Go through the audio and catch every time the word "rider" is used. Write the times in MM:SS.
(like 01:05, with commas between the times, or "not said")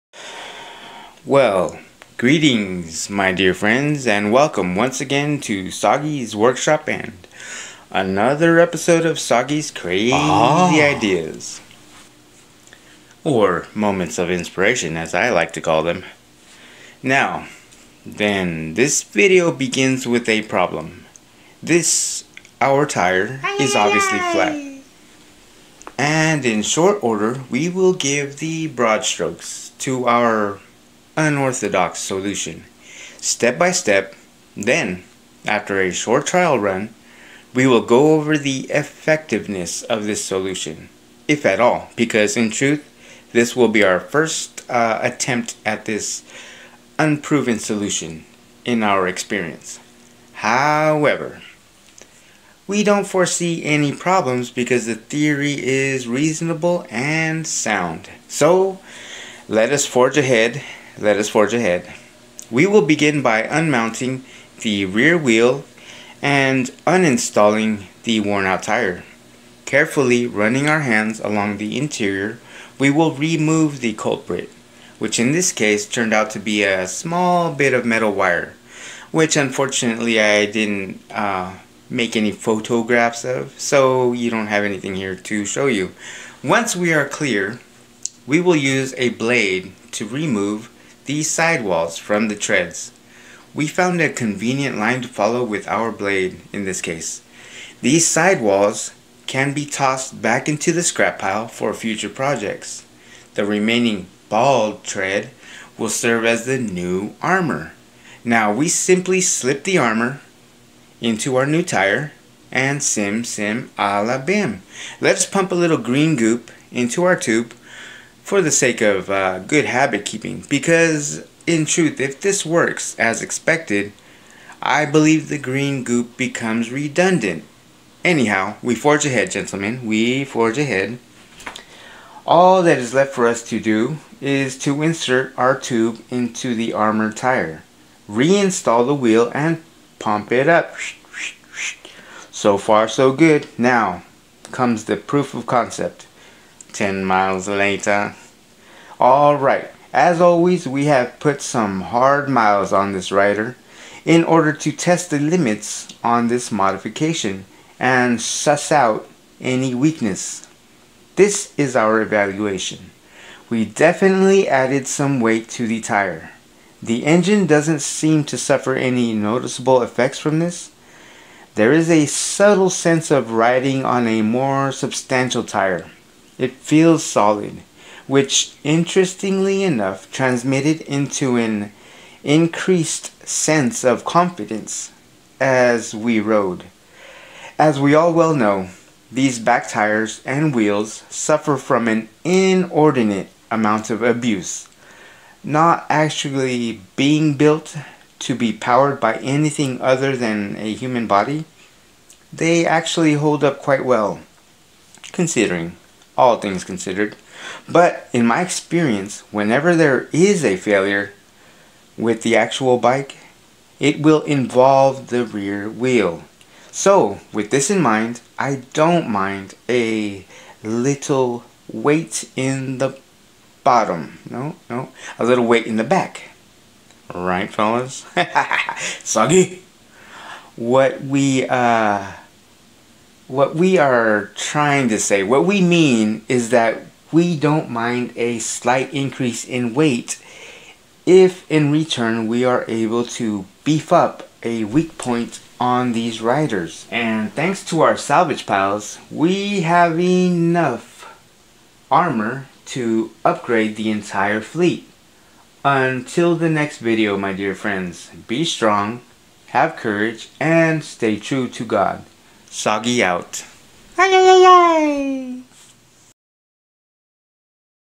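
02:33, 04:06.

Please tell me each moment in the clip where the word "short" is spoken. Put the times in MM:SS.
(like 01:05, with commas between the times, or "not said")
00:26, 00:35.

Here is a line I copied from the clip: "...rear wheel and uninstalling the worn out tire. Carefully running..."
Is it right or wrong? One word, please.
right.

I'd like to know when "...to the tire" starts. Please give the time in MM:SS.
02:45.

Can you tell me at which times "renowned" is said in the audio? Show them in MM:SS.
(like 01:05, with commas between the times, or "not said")
not said.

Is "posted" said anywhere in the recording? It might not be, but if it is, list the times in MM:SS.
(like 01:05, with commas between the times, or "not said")
not said.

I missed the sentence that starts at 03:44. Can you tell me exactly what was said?
No, no, a little weight in the back.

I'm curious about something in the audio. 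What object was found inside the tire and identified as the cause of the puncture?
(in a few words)
small bit of metal wire.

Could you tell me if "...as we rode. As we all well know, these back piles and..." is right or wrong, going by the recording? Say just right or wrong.
wrong.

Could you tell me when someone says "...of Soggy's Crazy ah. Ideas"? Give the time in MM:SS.
00:09.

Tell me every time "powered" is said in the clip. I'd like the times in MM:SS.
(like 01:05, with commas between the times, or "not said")
03:18.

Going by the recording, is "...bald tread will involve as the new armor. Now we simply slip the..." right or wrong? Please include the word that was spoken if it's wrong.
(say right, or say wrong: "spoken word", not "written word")
wrong: "serve", not "involve".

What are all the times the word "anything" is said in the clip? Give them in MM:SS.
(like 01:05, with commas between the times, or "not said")
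01:24, 03:19.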